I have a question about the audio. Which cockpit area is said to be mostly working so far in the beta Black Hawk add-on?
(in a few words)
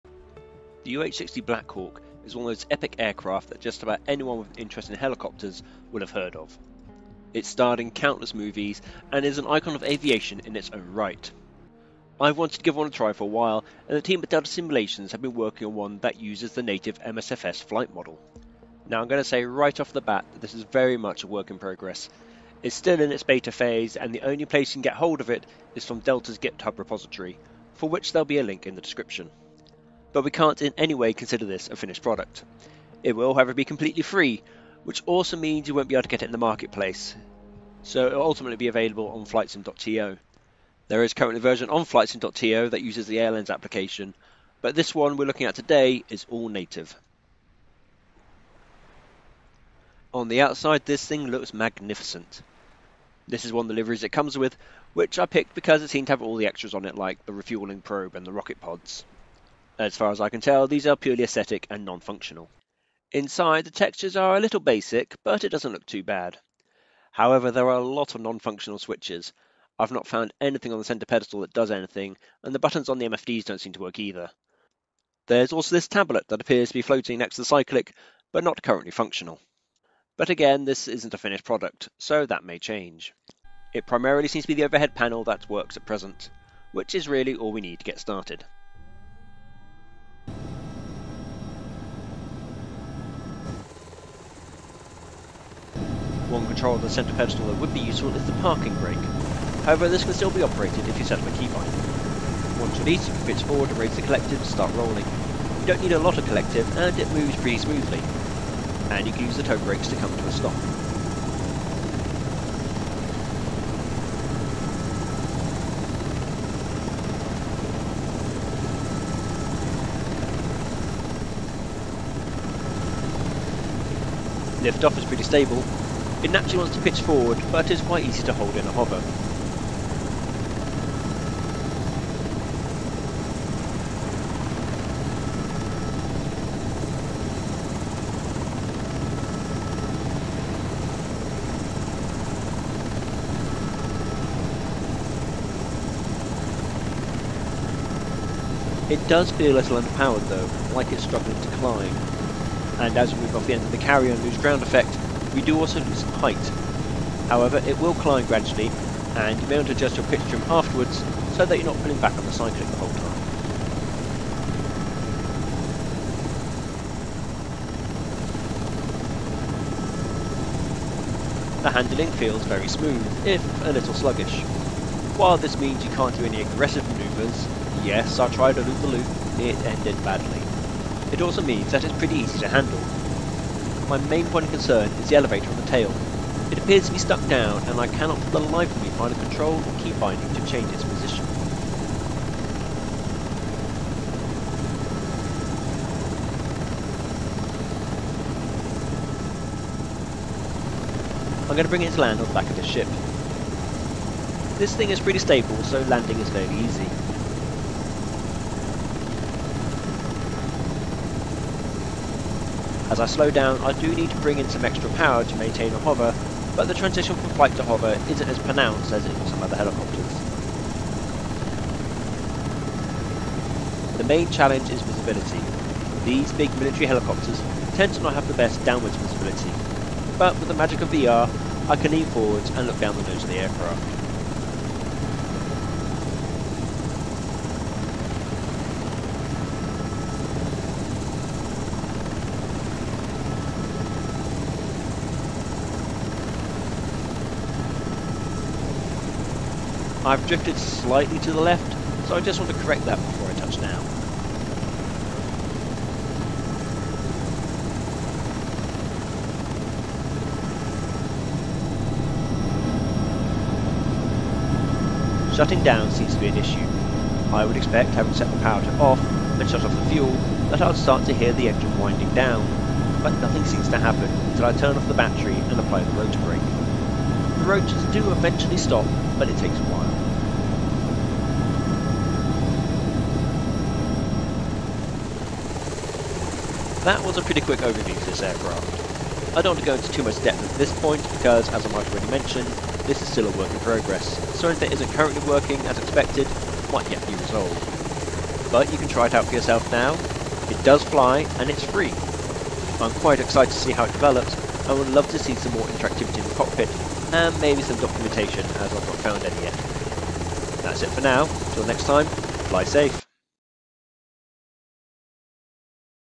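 overhead panel.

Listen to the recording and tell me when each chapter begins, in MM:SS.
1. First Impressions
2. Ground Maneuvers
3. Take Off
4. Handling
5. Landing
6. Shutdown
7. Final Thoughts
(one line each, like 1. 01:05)
1. 00:48
2. 01:36
3. 02:03
4. 02:47
5. 03:20
6. 04:22
7. 04:45.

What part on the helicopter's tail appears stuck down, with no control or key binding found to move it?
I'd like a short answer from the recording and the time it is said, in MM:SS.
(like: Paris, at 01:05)
the elevator, at 03:05.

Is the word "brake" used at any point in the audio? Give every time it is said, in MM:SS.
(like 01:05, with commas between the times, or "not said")
01:38, 01:49, 04:36.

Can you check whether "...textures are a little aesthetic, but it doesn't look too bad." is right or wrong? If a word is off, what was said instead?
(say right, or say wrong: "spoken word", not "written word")
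wrong: "basic", not "aesthetic".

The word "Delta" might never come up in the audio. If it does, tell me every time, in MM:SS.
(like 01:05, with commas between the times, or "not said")
00:14, 00:25.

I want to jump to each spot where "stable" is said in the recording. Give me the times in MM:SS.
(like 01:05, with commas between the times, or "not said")
02:05, 03:25.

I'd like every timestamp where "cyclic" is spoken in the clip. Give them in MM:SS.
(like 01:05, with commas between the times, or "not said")
01:17, 02:42.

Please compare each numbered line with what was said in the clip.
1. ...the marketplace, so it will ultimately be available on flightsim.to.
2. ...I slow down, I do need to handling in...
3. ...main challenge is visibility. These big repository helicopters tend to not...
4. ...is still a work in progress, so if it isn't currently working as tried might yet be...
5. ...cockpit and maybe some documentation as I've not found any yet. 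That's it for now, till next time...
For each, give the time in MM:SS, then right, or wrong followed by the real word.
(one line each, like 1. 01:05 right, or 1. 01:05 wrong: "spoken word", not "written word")
1. 00:36 right
2. 03:32 wrong: "bring", not "handling"
3. 03:44 wrong: "military", not "repository"
4. 04:53 wrong: "expected", not "tried"
5. 05:06 right.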